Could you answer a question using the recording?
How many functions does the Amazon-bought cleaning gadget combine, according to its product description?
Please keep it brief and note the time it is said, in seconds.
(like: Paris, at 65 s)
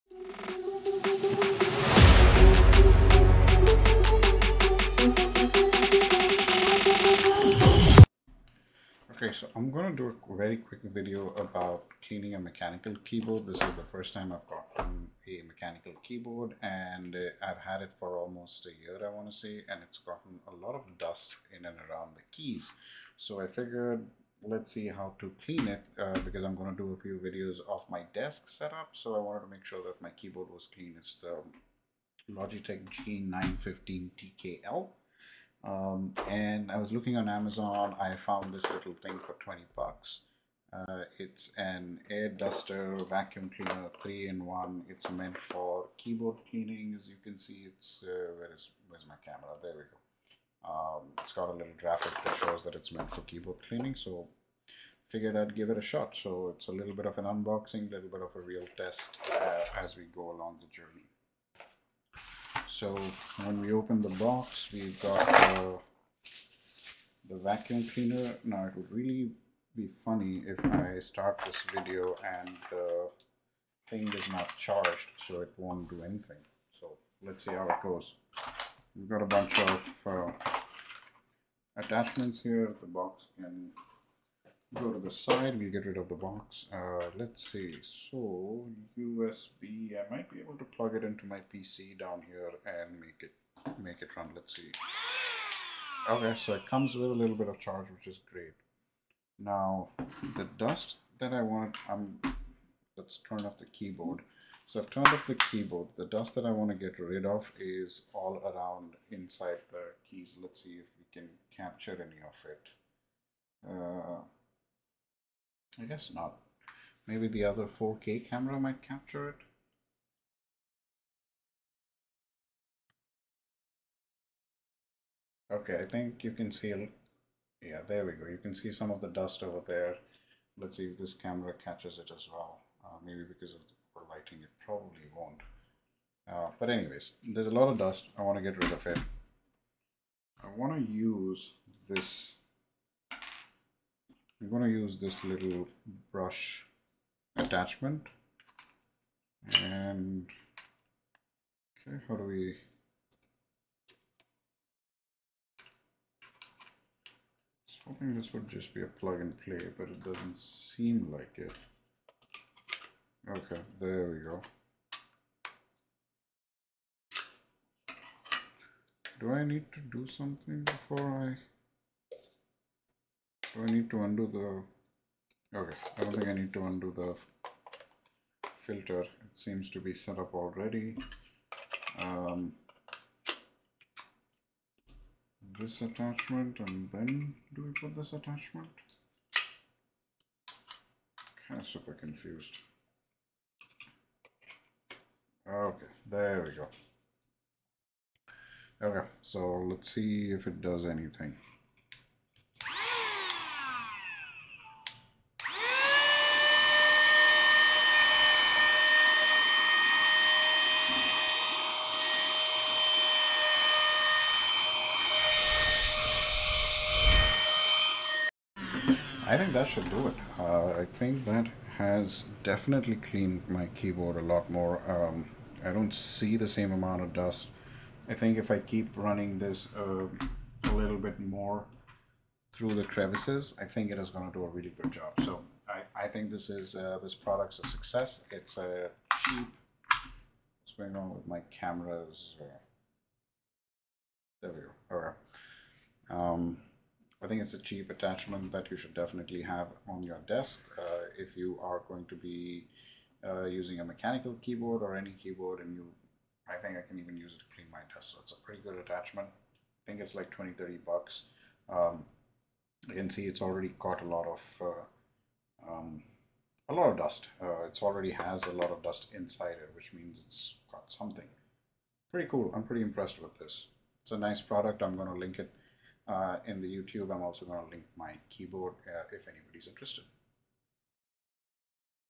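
3, at 44 s.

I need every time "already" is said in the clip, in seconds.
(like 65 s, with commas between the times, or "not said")
180 s, 263 s, 267 s.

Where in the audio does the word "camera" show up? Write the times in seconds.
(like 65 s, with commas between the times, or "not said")
49 s, 118 s, 131 s, 241 s.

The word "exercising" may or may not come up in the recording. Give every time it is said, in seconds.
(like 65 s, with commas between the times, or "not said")
not said.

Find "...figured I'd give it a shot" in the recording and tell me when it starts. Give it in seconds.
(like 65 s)
55 s.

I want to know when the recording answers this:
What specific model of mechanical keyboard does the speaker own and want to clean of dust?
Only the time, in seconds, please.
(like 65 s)
32 s.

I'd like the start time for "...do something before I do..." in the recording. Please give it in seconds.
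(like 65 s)
169 s.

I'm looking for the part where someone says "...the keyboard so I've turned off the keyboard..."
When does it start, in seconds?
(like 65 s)
103 s.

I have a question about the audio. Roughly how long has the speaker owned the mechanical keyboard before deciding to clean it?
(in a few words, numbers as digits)
almost a year.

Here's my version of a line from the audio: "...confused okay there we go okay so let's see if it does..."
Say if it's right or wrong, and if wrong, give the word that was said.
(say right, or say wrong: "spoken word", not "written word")
right.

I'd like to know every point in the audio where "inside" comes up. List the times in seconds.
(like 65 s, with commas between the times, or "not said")
109 s, 269 s.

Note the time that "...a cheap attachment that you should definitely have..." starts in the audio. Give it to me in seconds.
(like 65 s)
247 s.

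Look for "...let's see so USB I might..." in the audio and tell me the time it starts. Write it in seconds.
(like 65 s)
87 s.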